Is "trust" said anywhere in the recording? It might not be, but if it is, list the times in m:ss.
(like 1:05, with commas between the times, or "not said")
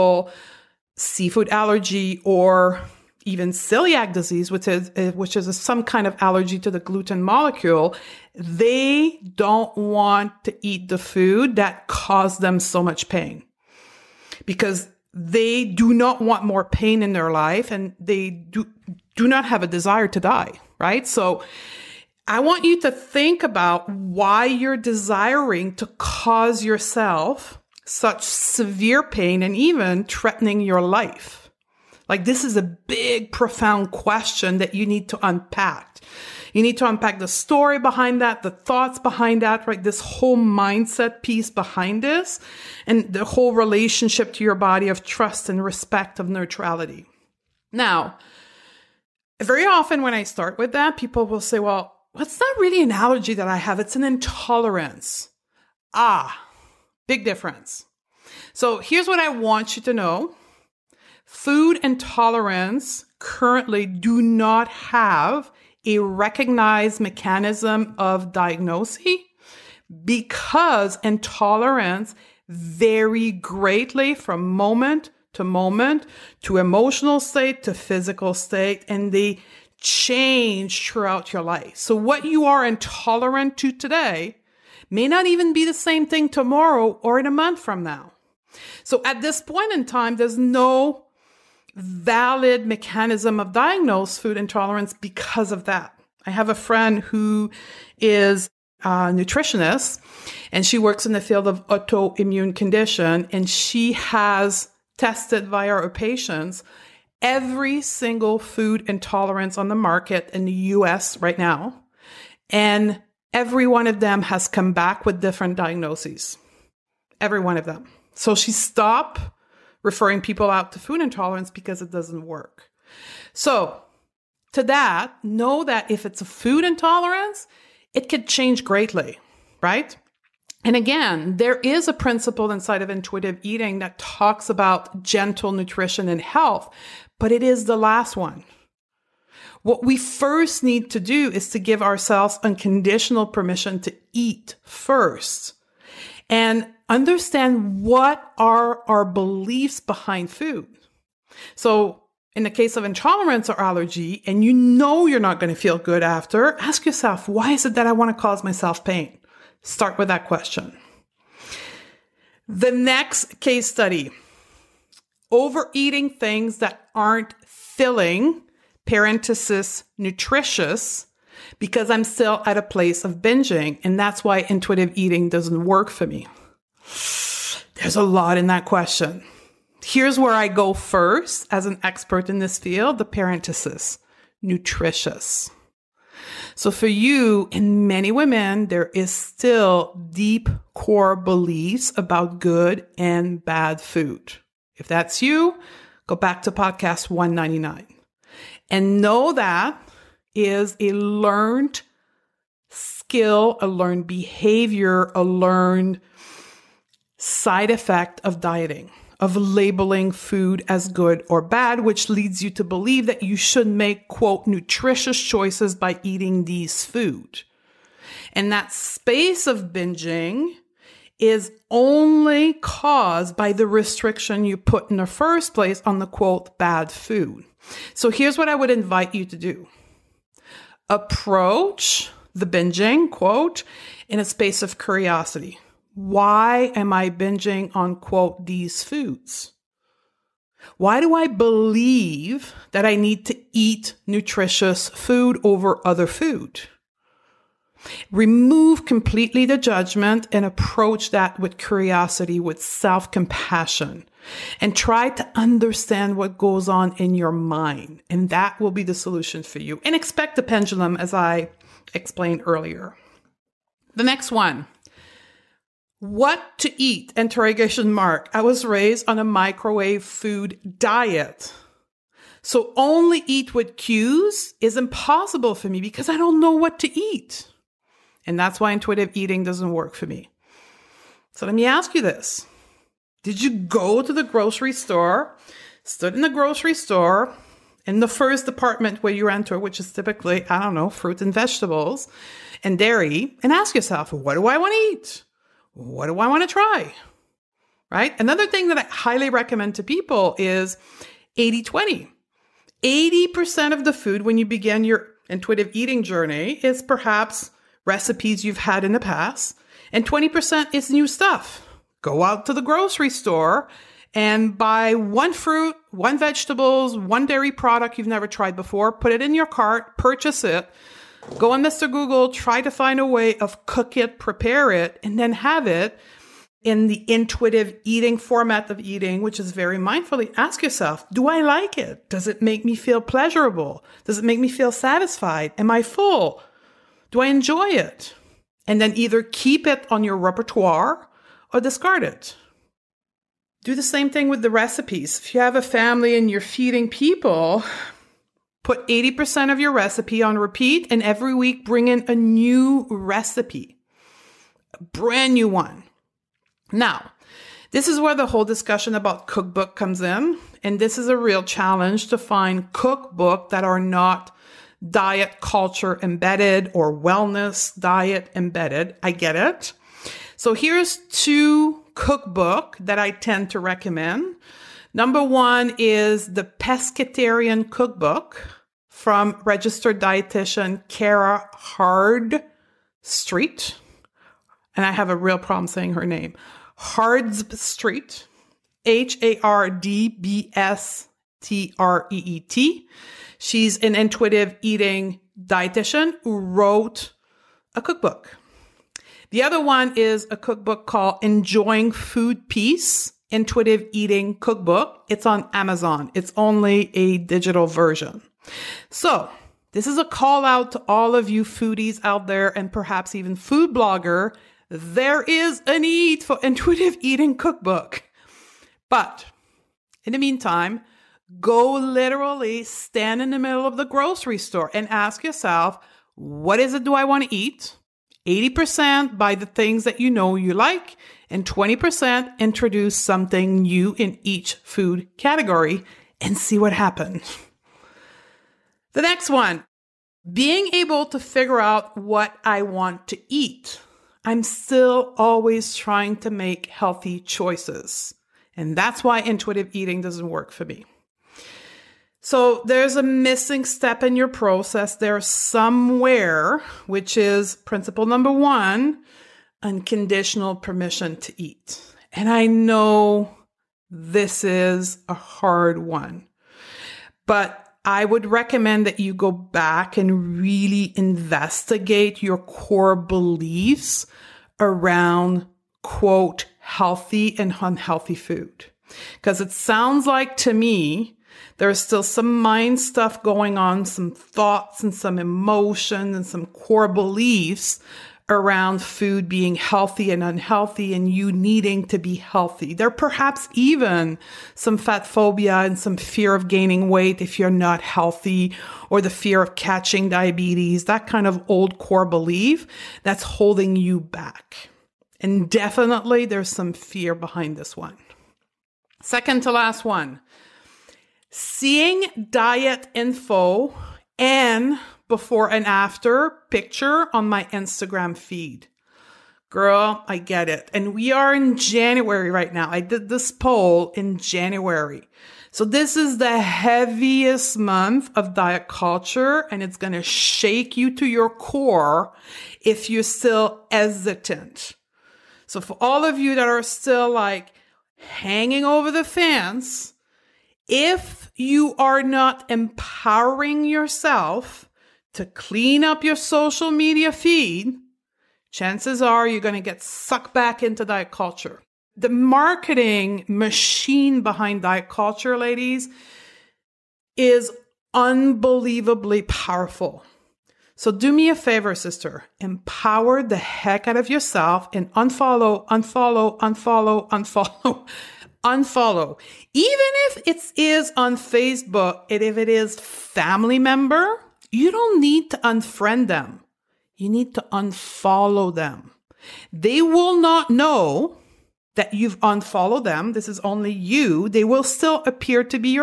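0:45.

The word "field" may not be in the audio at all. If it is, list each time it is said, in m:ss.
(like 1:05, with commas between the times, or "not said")
1:41, 3:02.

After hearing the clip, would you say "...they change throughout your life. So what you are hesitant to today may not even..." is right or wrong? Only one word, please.
wrong.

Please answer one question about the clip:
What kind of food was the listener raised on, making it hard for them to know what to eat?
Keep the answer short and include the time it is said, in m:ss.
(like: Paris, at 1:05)
Microwave food, at 4:29.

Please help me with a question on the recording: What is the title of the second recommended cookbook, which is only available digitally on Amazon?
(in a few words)
Enjoying Food Peace Intuitive Eating Cookbook.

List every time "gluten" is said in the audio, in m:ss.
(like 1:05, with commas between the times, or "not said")
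0:06.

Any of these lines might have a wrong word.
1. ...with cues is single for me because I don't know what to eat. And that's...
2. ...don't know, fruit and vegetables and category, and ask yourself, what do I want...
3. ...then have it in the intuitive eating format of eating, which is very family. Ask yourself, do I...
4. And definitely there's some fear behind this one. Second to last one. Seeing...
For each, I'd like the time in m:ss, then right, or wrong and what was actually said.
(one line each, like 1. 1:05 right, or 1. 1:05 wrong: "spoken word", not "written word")
1. 4:33 wrong: "impossible", not "single"
2. 4:50 wrong: "dairy", not "category"
3. 5:25 wrong: "mindfully", not "family"
4. 8:25 right.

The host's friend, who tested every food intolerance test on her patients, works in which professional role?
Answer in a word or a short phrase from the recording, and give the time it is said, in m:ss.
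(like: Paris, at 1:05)
Nutritionist, at 1:39.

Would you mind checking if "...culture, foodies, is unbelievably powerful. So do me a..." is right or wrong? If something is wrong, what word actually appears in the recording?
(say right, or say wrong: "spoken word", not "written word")
wrong: "ladies", not "foodies".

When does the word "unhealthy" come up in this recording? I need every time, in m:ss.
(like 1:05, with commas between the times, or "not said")
7:57, 8:10.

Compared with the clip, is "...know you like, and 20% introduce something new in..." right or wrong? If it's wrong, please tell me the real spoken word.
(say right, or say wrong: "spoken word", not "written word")
right.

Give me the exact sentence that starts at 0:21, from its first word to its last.
So I want you to think about why you're desiring to cause yourself such severe pain and even threatening your life.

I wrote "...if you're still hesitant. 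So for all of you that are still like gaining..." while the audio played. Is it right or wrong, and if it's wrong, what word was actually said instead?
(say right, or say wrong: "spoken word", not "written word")
wrong: "hanging", not "gaining".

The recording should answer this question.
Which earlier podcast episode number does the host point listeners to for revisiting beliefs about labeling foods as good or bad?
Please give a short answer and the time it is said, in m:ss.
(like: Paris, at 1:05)
199, at 3:17.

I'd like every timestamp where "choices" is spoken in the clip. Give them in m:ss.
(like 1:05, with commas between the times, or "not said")
3:35, 7:27.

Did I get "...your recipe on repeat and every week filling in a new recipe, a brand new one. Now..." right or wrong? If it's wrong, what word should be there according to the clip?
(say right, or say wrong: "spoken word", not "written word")
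wrong: "bring", not "filling".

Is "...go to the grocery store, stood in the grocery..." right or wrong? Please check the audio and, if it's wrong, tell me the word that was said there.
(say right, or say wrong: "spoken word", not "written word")
right.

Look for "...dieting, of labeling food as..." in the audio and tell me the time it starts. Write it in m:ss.
3:28.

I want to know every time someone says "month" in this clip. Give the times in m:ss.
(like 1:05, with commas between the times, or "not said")
1:27, 8:47.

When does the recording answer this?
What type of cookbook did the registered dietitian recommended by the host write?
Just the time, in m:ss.
6:16.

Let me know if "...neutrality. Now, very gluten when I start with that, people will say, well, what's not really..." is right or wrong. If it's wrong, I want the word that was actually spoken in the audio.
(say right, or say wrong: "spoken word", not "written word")
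wrong: "often", not "gluten".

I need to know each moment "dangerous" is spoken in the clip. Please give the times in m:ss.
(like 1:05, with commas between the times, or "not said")
not said.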